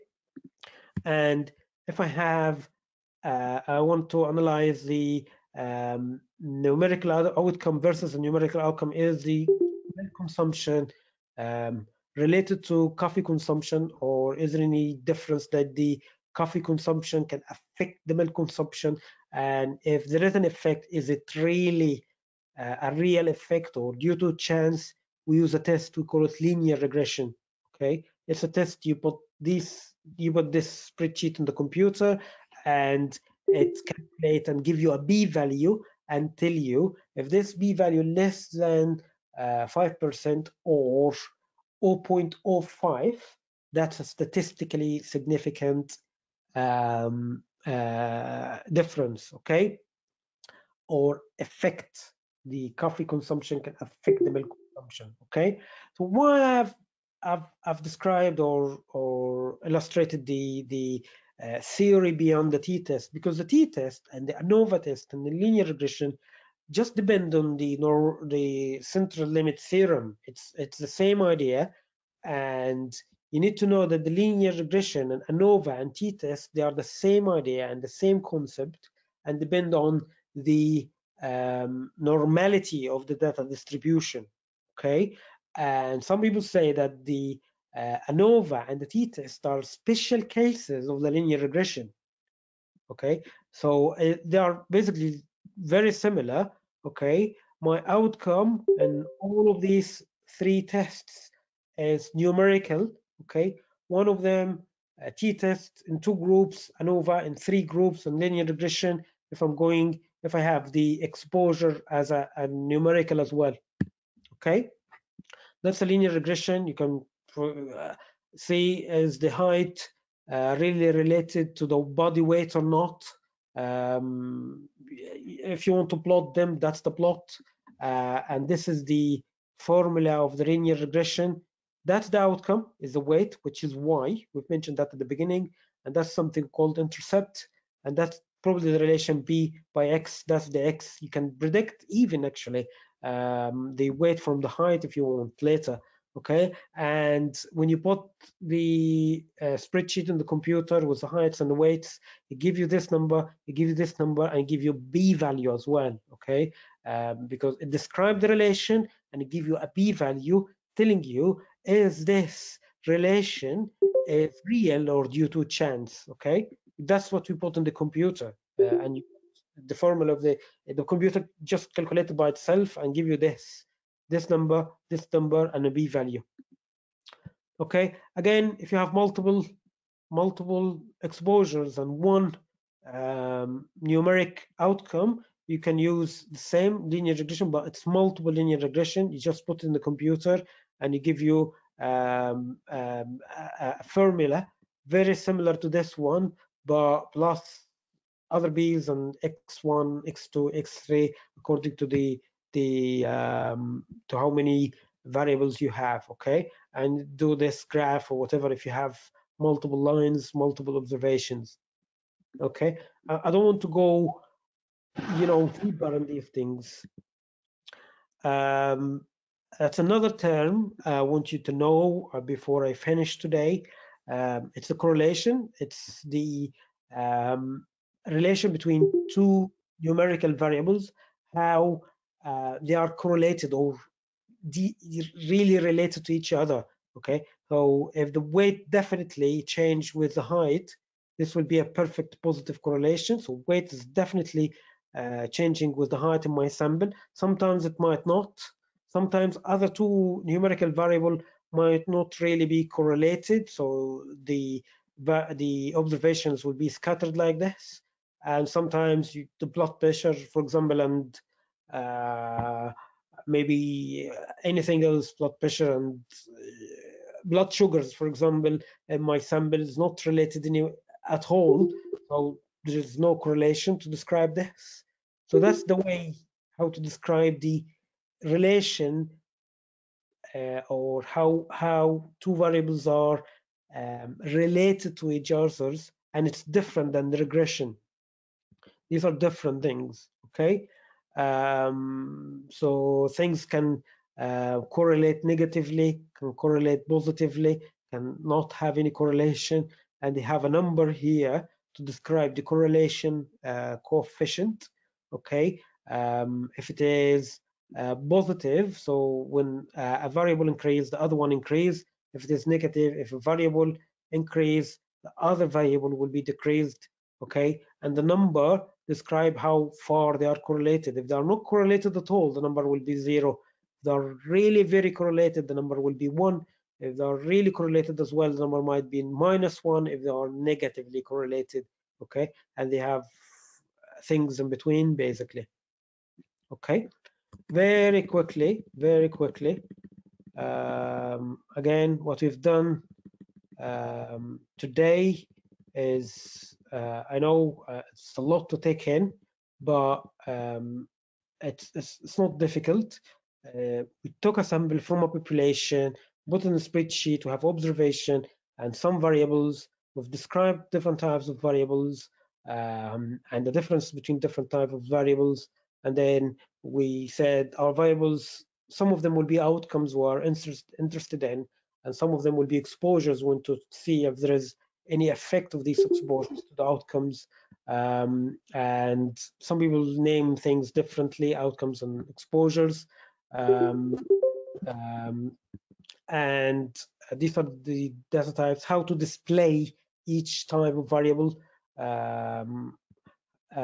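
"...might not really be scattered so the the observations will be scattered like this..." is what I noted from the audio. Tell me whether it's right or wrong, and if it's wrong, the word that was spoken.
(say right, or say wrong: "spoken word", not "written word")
wrong: "correlated", not "scattered".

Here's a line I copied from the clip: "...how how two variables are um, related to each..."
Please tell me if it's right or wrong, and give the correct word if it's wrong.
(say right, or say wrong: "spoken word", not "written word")
right.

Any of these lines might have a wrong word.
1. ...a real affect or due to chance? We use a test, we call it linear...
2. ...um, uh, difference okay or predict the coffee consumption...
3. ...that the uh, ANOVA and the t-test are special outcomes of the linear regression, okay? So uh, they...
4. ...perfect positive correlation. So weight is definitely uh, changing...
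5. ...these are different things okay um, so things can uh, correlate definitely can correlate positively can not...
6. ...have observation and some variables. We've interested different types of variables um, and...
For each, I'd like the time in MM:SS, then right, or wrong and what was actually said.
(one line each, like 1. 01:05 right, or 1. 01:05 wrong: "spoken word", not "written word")
1. 00:22 wrong: "effect", not "affect"
2. 00:46 wrong: "affect", not "predict"
3. 01:26 wrong: "cases", not "outcomes"
4. 04:01 right
5. 04:48 wrong: "negatively", not "definitely"
6. 05:57 wrong: "described", not "interested".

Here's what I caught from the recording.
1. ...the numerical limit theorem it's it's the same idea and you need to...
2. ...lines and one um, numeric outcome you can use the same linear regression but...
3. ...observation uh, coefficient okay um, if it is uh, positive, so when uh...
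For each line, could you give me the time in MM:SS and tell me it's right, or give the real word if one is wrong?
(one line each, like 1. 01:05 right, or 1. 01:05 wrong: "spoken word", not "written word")
1. 01:08 wrong: "central", not "numerical"
2. 03:01 wrong: "exposures", not "lines"
3. 05:02 wrong: "correlation", not "observation".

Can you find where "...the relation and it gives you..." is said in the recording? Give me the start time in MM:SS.
02:38.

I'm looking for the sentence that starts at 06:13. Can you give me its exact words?
We want to see if there is any effect of these exposures to the outcomes.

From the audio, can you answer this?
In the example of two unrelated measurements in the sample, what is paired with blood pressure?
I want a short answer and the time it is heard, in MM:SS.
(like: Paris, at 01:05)
blood sugars, at 04:27.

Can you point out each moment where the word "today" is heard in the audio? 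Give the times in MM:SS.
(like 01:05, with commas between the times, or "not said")
03:43, 05:44.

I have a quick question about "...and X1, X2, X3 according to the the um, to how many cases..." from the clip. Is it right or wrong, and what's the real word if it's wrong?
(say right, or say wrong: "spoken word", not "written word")
wrong: "variables", not "cases".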